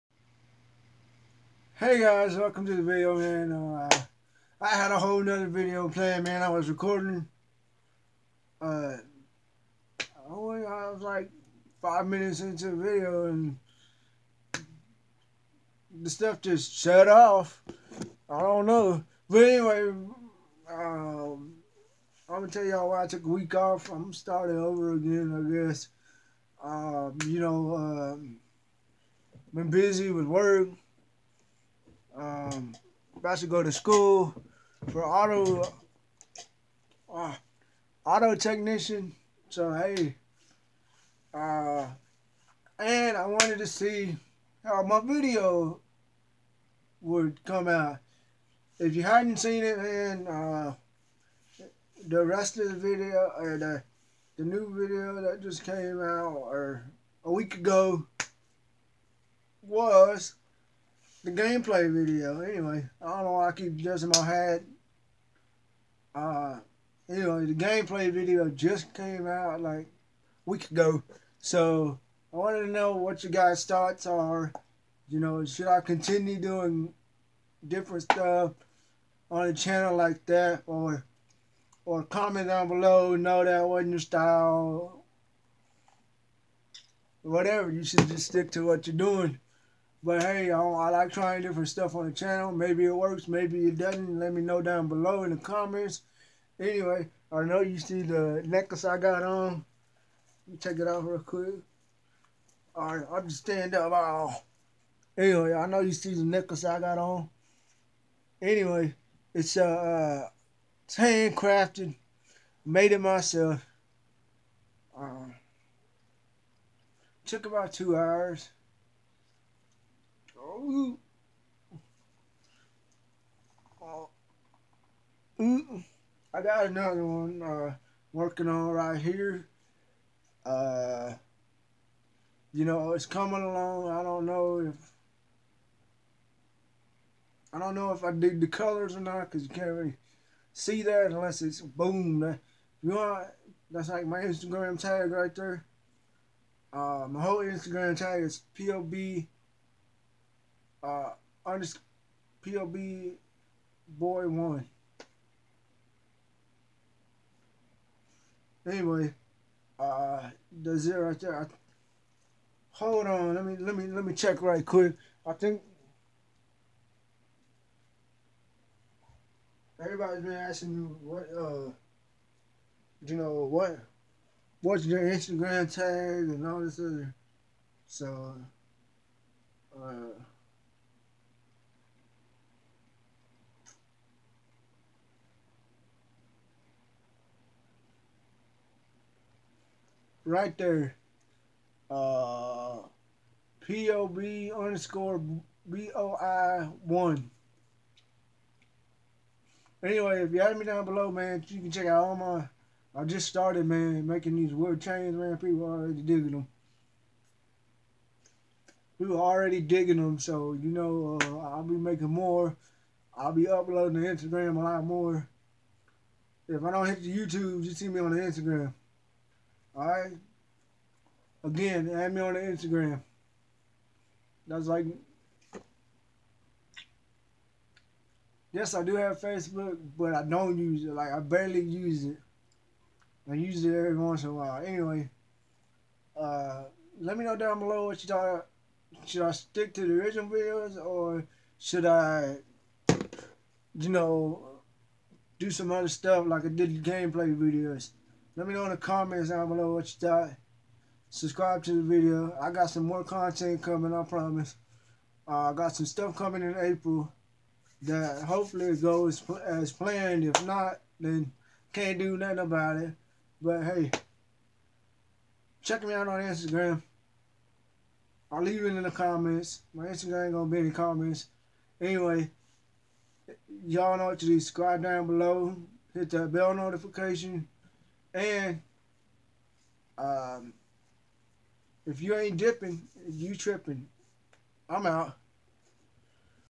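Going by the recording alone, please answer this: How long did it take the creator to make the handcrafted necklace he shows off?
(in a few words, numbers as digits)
about 2 hours.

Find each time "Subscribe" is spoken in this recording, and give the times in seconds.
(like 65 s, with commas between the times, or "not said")
251 s, 274 s.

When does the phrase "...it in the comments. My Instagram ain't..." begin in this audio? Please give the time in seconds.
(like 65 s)
268 s.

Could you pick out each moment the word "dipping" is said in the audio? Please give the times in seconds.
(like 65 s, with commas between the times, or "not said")
282 s.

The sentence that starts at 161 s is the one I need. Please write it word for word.
I, hold on, let me let me let me check right quick.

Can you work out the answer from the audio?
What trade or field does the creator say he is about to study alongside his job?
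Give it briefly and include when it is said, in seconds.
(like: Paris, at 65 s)
auto technician, at 38 s.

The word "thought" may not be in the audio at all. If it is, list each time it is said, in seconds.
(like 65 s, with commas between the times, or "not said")
73 s, 238 s, 250 s.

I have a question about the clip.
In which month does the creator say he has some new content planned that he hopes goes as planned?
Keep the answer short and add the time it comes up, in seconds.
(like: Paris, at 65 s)
April, at 256 s.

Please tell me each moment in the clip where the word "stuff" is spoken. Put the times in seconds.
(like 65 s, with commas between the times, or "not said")
16 s, 78 s, 91 s, 245 s, 255 s.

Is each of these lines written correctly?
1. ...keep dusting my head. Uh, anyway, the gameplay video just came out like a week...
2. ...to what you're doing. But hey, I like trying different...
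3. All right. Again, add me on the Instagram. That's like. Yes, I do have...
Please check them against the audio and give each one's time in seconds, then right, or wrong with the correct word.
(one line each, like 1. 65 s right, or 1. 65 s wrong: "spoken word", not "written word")
1. 63 s right
2. 88 s right
3. 219 s right.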